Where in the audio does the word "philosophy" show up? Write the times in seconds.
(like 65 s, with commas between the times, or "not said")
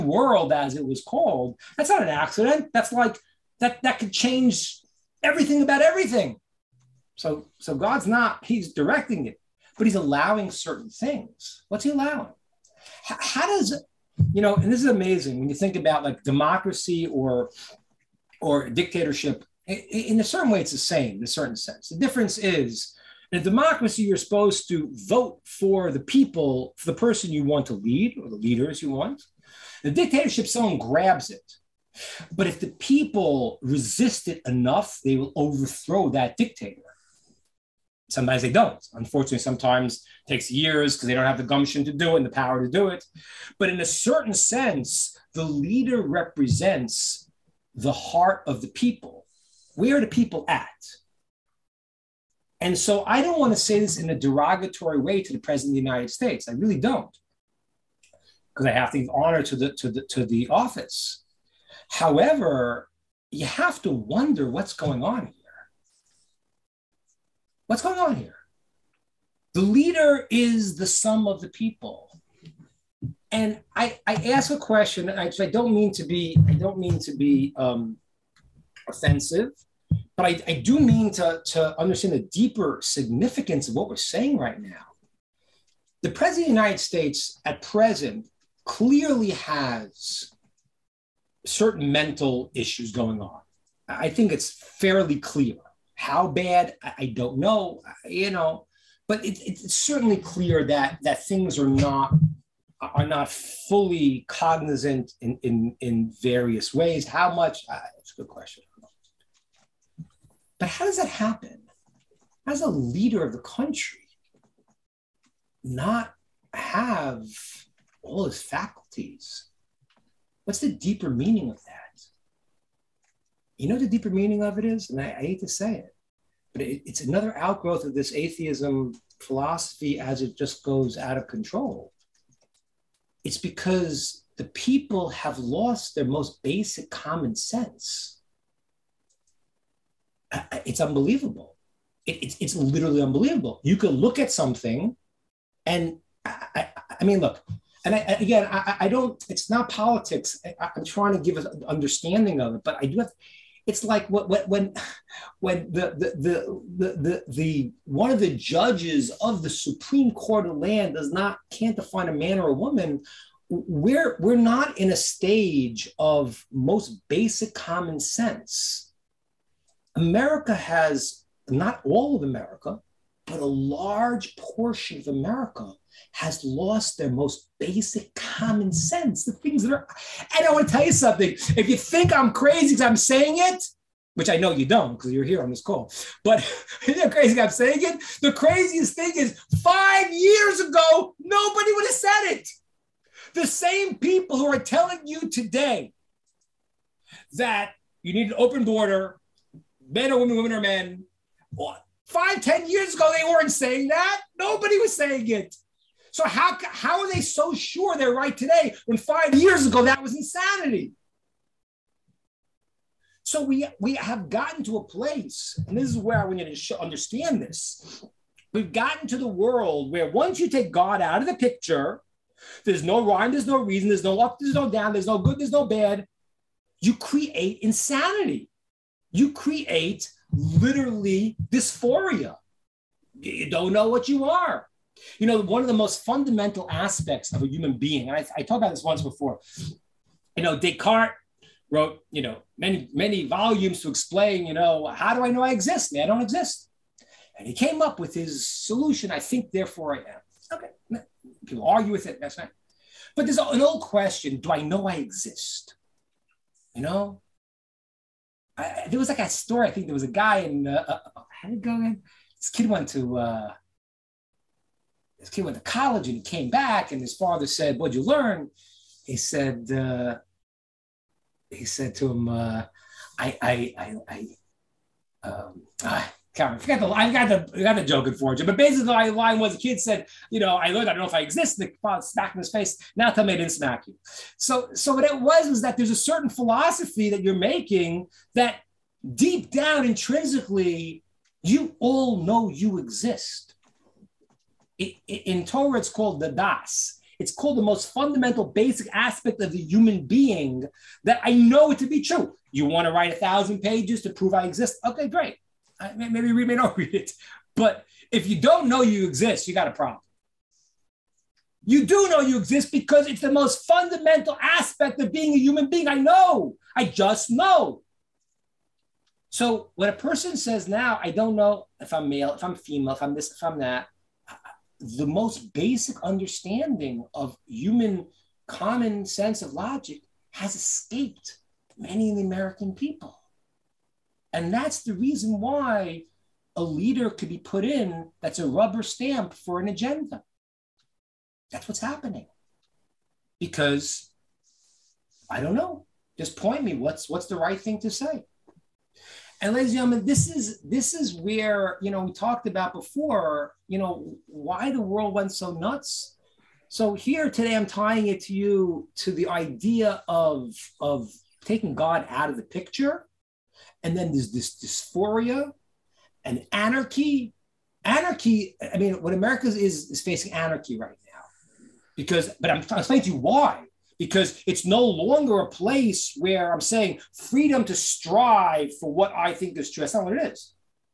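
129 s, 286 s.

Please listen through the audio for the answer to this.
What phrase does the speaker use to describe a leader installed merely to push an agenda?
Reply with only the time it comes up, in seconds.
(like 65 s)
338 s.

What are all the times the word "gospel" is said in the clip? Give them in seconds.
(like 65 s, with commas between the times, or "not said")
not said.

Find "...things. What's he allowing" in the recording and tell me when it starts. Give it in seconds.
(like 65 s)
10 s.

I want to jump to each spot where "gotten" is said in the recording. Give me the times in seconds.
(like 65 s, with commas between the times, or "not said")
214 s, 218 s.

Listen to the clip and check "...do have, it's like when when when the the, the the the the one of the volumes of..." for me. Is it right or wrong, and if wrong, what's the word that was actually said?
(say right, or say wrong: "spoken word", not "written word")
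wrong: "judges", not "volumes".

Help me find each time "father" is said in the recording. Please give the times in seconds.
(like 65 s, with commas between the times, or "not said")
267 s, 281 s.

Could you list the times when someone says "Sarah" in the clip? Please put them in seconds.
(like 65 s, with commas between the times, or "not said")
not said.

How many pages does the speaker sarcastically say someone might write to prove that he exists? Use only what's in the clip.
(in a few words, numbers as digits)
1000.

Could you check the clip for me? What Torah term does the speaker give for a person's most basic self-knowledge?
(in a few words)
das.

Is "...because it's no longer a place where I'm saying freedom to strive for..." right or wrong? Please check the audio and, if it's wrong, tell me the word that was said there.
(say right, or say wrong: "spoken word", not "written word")
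right.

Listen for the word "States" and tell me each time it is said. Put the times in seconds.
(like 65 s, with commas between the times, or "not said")
56 s, 86 s.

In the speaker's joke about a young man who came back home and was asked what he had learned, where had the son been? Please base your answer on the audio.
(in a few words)
college.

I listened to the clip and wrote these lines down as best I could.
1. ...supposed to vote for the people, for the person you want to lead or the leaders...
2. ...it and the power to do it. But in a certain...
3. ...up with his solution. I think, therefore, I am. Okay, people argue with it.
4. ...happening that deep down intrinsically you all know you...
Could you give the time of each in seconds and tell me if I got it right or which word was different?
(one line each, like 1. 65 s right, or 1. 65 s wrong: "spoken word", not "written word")
1. 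24 s right
2. 42 s right
3. 247 s right
4. 287 s wrong: "making", not "happening".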